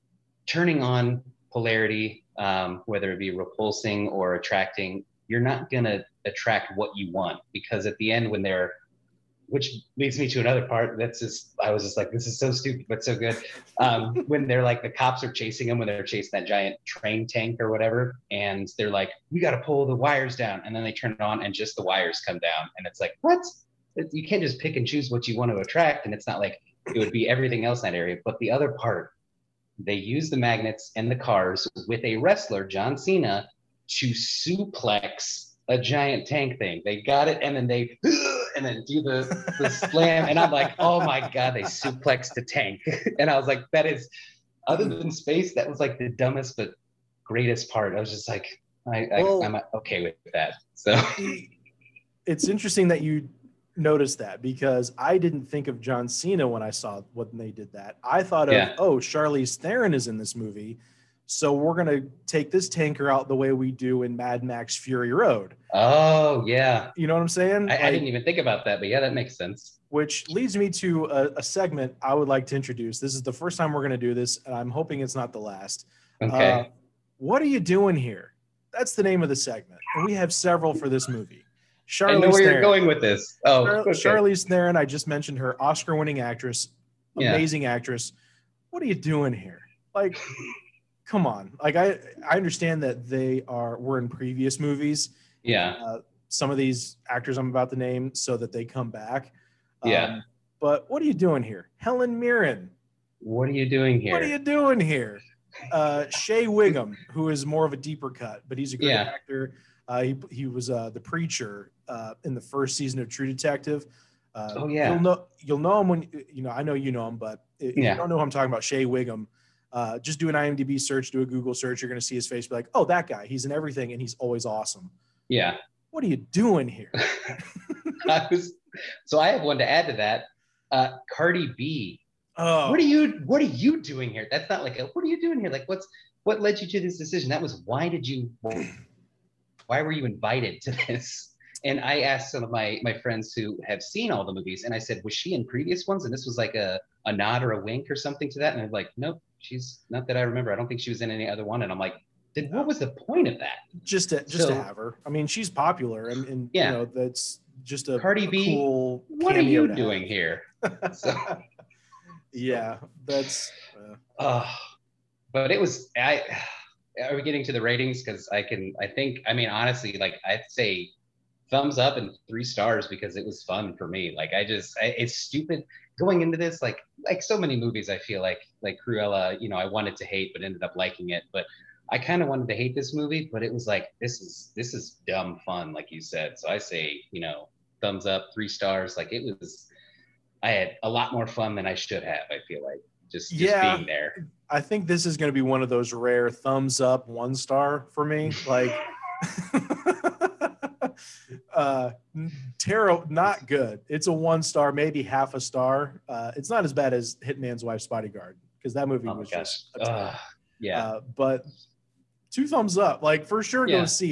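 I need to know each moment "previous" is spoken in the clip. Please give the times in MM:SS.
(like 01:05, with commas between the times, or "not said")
01:34, 02:25.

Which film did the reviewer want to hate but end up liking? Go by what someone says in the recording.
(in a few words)
Cruella.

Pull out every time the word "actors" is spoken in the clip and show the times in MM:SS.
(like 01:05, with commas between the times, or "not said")
01:37, 01:49.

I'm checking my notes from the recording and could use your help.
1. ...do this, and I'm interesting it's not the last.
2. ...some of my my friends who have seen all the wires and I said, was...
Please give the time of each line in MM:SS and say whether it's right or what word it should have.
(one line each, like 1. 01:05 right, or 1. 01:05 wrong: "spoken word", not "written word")
1. 01:13 wrong: "hoping", not "interesting"
2. 02:22 wrong: "movies", not "wires".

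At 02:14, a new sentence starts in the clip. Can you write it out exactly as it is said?
That's not like a, what are you doing here?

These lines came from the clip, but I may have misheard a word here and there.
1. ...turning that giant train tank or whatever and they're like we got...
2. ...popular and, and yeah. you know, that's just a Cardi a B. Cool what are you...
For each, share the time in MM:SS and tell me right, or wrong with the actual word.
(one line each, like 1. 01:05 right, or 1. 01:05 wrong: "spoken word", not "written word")
1. 00:16 wrong: "chasing", not "turning"
2. 02:35 right.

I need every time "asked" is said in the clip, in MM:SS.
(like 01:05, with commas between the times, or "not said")
02:22.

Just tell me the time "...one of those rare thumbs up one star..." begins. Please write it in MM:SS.
03:15.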